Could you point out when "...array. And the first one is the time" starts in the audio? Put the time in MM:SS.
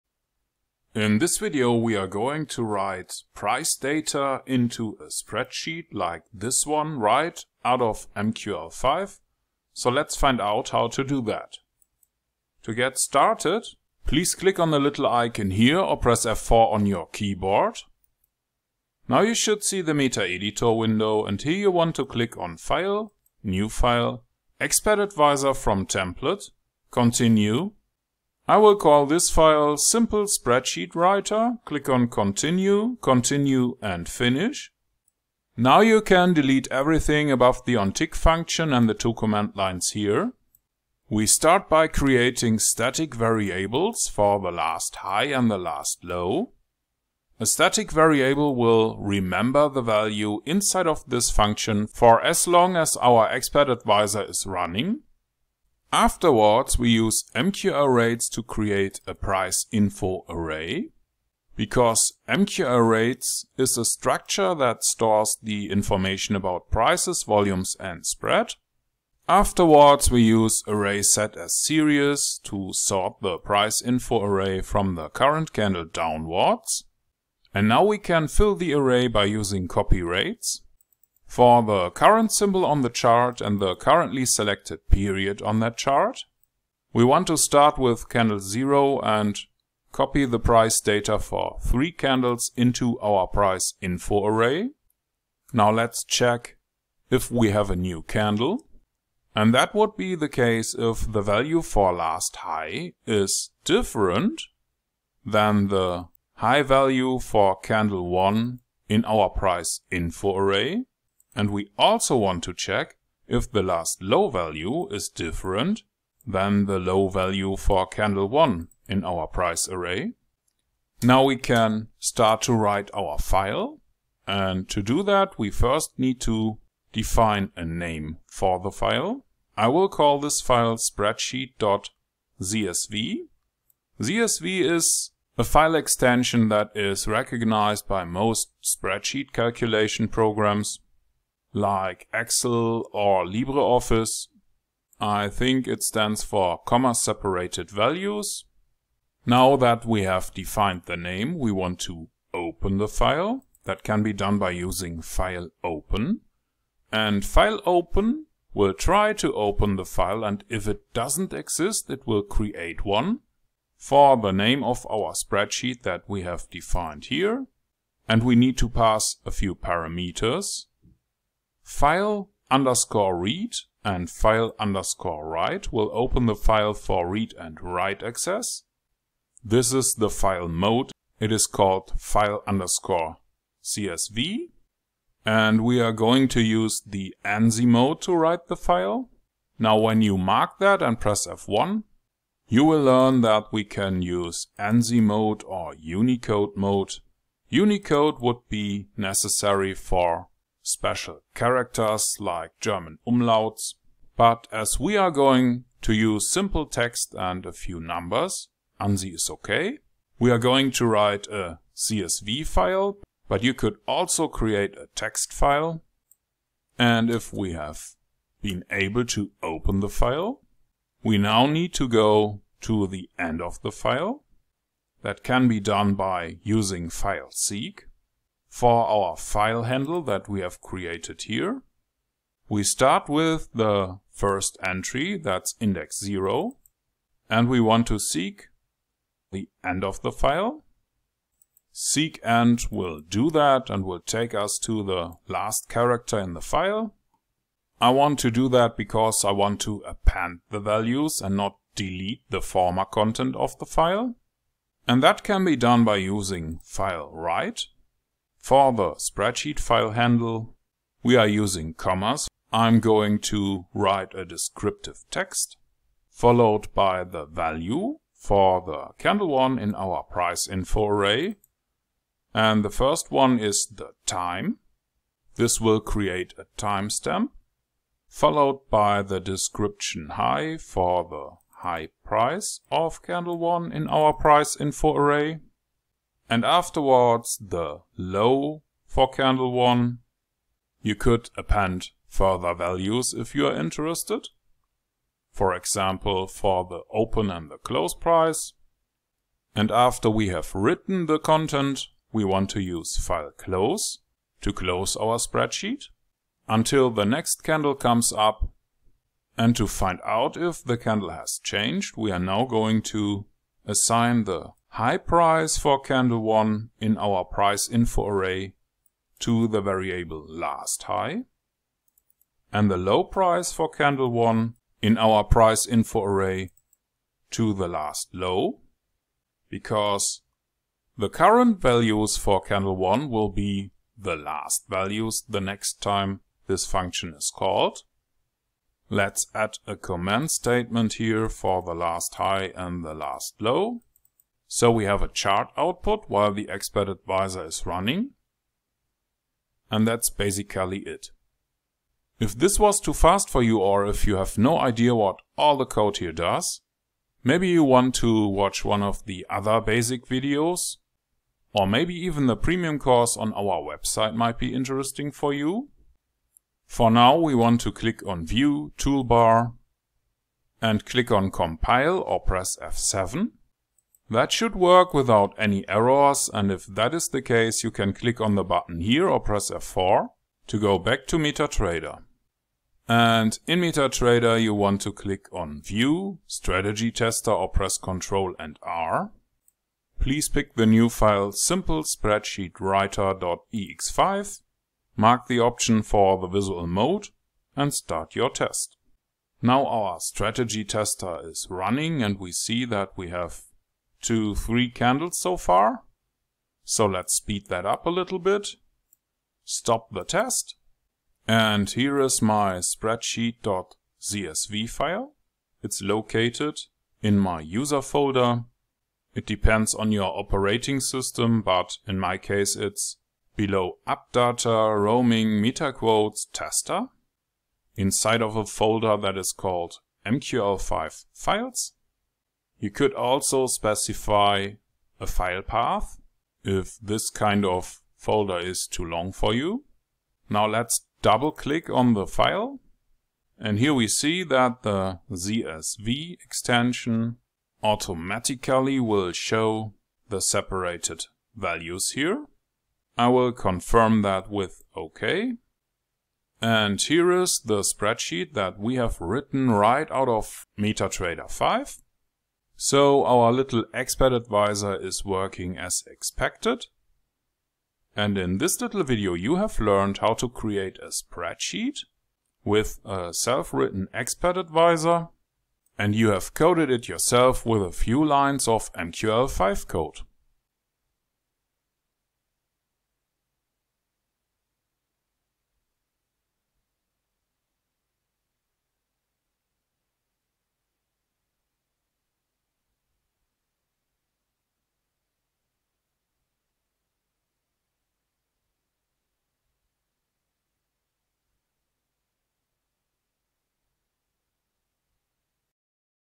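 04:30.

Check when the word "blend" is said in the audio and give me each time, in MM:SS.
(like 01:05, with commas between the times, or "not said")
not said.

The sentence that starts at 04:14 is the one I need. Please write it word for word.
And that can be done by using file write for the spreadsheet file handle, we are using commas.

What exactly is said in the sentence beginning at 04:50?
You could append further values if you are interested.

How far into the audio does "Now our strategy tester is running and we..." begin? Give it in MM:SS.
06:39.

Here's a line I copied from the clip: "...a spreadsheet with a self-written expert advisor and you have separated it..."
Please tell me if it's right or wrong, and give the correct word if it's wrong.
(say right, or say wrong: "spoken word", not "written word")
wrong: "coded", not "separated".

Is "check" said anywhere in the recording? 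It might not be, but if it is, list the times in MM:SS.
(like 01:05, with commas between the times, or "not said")
01:36, 01:52.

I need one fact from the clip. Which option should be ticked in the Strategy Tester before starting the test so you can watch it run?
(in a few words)
visual mode.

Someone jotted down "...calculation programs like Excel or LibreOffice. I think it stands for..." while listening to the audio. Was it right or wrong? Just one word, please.
right.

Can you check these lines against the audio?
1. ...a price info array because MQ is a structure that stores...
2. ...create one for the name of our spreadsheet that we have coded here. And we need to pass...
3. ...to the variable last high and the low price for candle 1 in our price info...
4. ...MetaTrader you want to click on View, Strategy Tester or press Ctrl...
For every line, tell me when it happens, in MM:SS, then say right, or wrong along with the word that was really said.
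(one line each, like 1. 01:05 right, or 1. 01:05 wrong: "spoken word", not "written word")
1. 00:59 right
2. 02:42 wrong: "defined", not "coded"
3. 05:19 right
4. 06:23 right.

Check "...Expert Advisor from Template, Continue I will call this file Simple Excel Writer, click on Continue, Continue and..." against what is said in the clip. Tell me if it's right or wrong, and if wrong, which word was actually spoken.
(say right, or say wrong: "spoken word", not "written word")
wrong: "Spreadsheet", not "Excel".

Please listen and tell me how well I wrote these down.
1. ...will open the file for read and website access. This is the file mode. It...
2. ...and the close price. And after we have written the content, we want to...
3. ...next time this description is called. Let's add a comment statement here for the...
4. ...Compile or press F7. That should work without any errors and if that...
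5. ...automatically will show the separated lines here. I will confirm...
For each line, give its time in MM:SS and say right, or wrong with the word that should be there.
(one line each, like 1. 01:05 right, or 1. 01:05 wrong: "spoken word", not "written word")
1. 02:55 wrong: "write", not "website"
2. 04:57 right
3. 05:35 wrong: "function", not "description"
4. 06:11 right
5. 07:27 wrong: "values", not "lines".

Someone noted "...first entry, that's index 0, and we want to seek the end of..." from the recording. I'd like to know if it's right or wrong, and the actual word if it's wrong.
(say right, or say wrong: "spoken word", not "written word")
right.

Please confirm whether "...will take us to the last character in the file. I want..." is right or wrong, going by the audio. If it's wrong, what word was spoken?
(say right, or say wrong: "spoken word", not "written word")
right.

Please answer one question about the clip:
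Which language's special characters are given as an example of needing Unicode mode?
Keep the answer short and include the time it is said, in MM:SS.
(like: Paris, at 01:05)
German umlauts, at 03:22.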